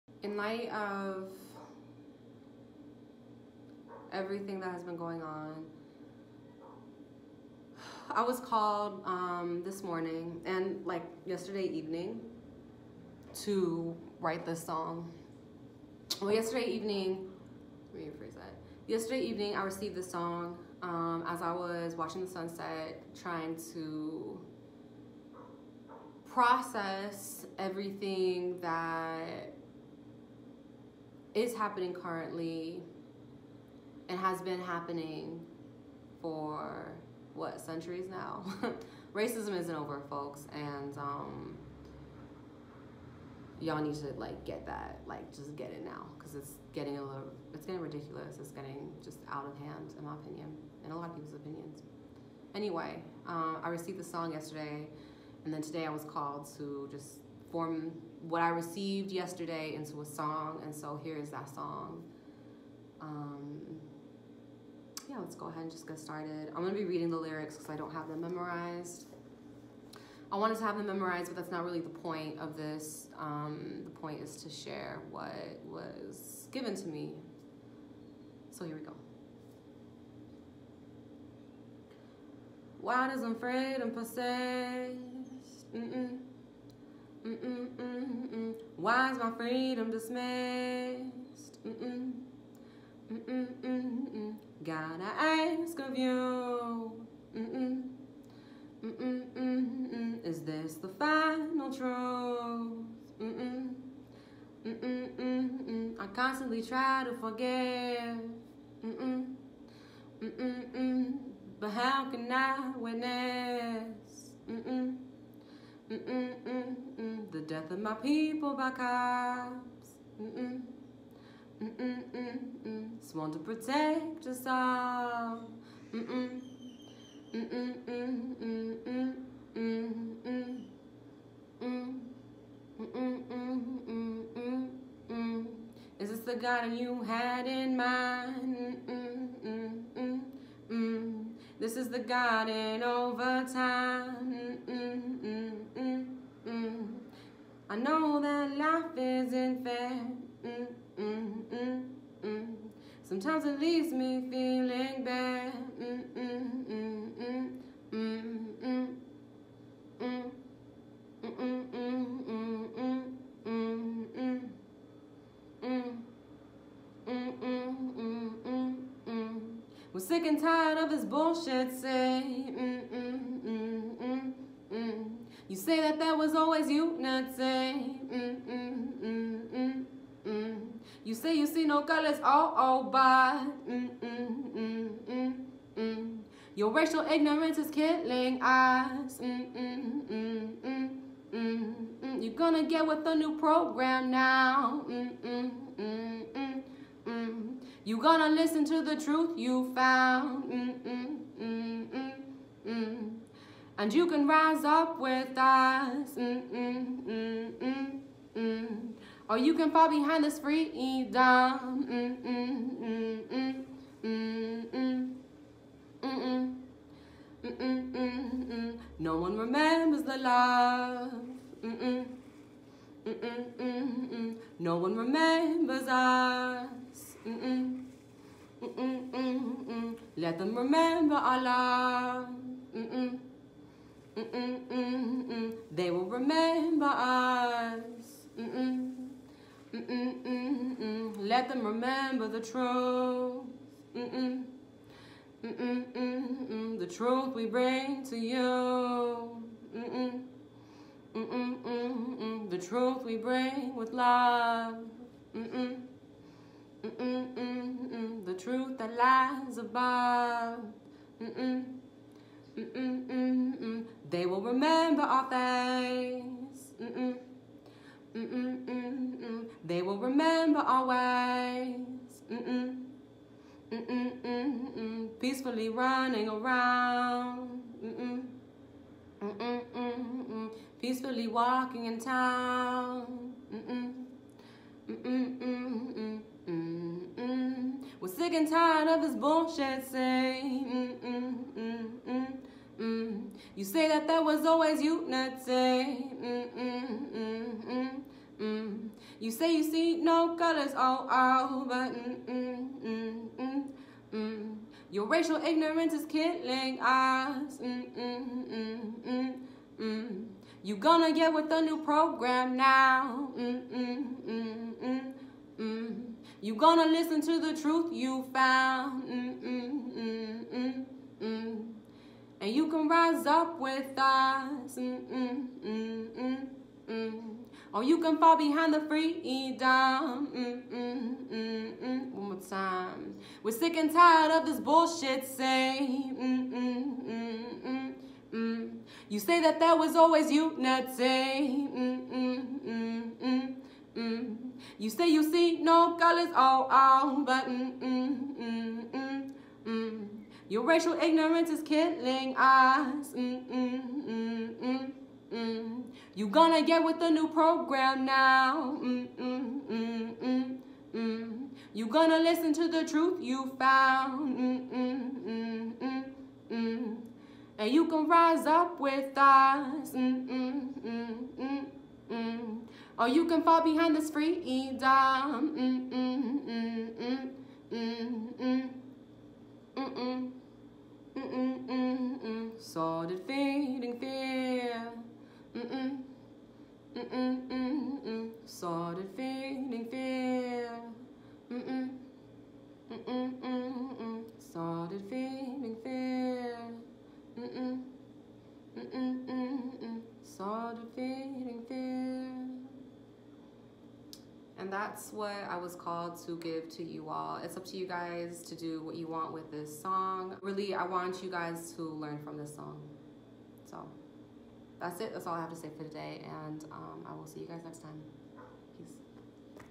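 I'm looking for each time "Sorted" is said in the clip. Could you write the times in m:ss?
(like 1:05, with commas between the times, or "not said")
6:22.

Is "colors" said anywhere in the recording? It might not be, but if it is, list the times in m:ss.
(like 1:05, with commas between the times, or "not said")
3:01, 5:00, 5:45.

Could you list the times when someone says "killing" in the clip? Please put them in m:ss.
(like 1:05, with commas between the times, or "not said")
3:07, 5:06, 5:51.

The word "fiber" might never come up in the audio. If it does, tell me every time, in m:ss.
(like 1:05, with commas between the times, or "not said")
not said.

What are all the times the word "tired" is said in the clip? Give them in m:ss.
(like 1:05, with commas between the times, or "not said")
2:50, 4:48, 5:33.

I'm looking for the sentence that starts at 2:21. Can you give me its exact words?
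This is the garden over time.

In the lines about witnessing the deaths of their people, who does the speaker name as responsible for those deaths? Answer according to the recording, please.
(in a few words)
cops.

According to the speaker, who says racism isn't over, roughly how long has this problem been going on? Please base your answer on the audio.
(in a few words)
centuries.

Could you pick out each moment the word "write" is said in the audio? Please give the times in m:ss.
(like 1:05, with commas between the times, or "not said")
0:14.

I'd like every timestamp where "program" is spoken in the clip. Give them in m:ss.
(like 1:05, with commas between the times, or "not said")
3:13, 5:11, 5:57.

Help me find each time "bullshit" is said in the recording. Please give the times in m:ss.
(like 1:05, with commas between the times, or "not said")
2:51, 4:49, 5:34.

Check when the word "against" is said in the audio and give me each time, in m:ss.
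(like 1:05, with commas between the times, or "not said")
not said.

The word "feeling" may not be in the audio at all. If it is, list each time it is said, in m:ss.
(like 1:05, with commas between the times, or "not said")
2:34, 6:29, 6:35, 6:40.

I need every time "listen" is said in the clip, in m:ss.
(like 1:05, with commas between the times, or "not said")
3:18, 5:16, 6:02.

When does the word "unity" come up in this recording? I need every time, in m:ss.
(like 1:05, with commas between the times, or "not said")
4:54, 5:40.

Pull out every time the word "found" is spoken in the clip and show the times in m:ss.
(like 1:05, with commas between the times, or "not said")
3:19, 5:18, 6:03.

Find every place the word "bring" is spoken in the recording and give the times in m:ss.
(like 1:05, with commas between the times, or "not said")
4:07, 4:13.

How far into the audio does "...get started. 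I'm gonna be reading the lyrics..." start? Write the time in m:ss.
1:05.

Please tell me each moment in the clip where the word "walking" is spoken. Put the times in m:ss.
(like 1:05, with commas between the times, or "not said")
4:41.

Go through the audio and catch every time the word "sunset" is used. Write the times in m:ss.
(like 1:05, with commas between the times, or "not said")
0:22.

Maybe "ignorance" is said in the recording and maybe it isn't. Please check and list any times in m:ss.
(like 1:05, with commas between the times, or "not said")
3:07, 5:05, 5:50.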